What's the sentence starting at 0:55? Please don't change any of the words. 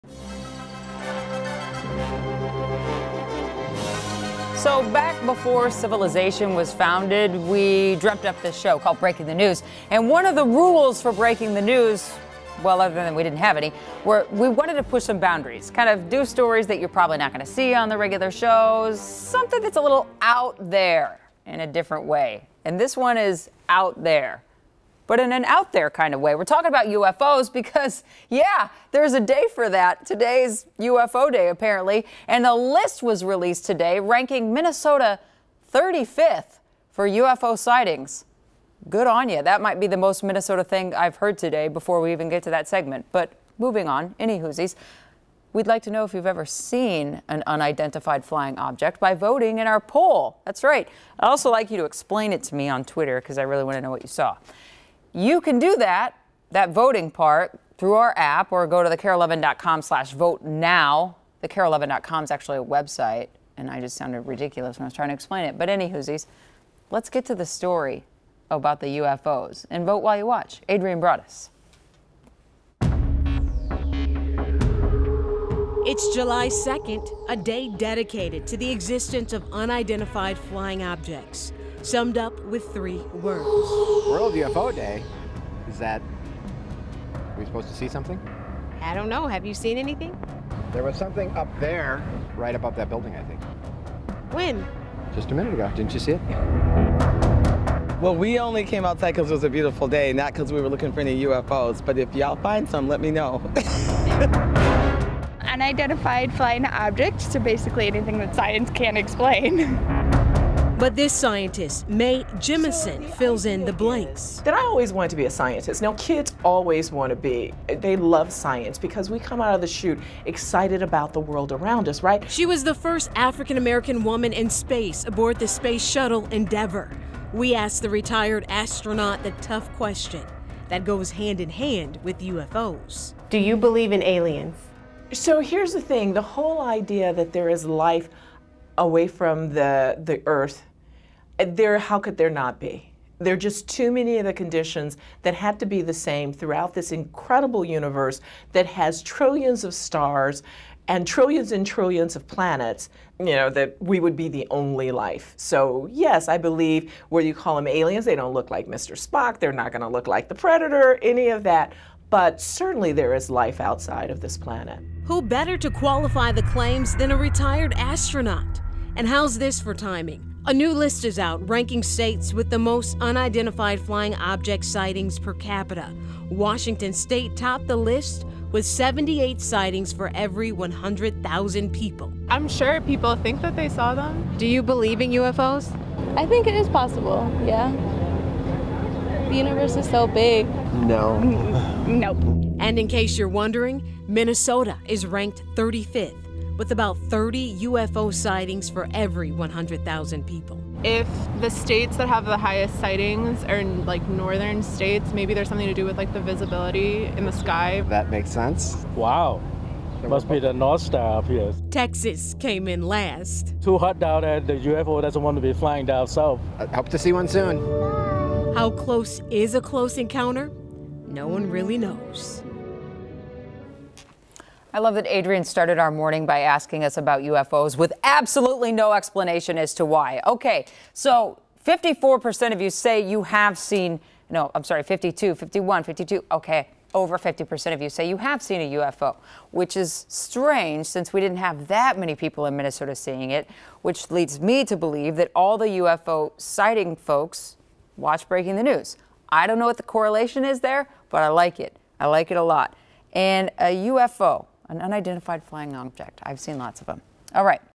You can do that, that voting part, through our app or go to thekare11.com slash vote now.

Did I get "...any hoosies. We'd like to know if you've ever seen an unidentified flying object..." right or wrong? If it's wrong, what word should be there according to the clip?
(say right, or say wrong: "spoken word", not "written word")
right.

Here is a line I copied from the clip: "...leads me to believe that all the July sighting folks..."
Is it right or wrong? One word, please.
wrong.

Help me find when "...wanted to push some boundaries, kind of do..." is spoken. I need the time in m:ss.
0:14.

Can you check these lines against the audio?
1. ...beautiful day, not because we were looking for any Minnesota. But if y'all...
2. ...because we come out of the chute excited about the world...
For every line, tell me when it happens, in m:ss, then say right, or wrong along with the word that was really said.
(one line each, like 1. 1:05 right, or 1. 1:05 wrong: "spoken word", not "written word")
1. 1:39 wrong: "UFOs", not "Minnesota"
2. 1:58 right.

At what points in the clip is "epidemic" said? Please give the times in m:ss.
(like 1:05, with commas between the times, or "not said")
not said.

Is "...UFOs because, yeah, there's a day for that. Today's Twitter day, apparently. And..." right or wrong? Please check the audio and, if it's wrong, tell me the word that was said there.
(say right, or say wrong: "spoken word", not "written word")
wrong: "UFO", not "Twitter".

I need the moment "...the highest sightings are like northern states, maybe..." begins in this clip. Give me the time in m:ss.
3:22.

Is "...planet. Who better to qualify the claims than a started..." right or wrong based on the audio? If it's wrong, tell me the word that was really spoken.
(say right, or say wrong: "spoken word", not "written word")
wrong: "retired", not "started".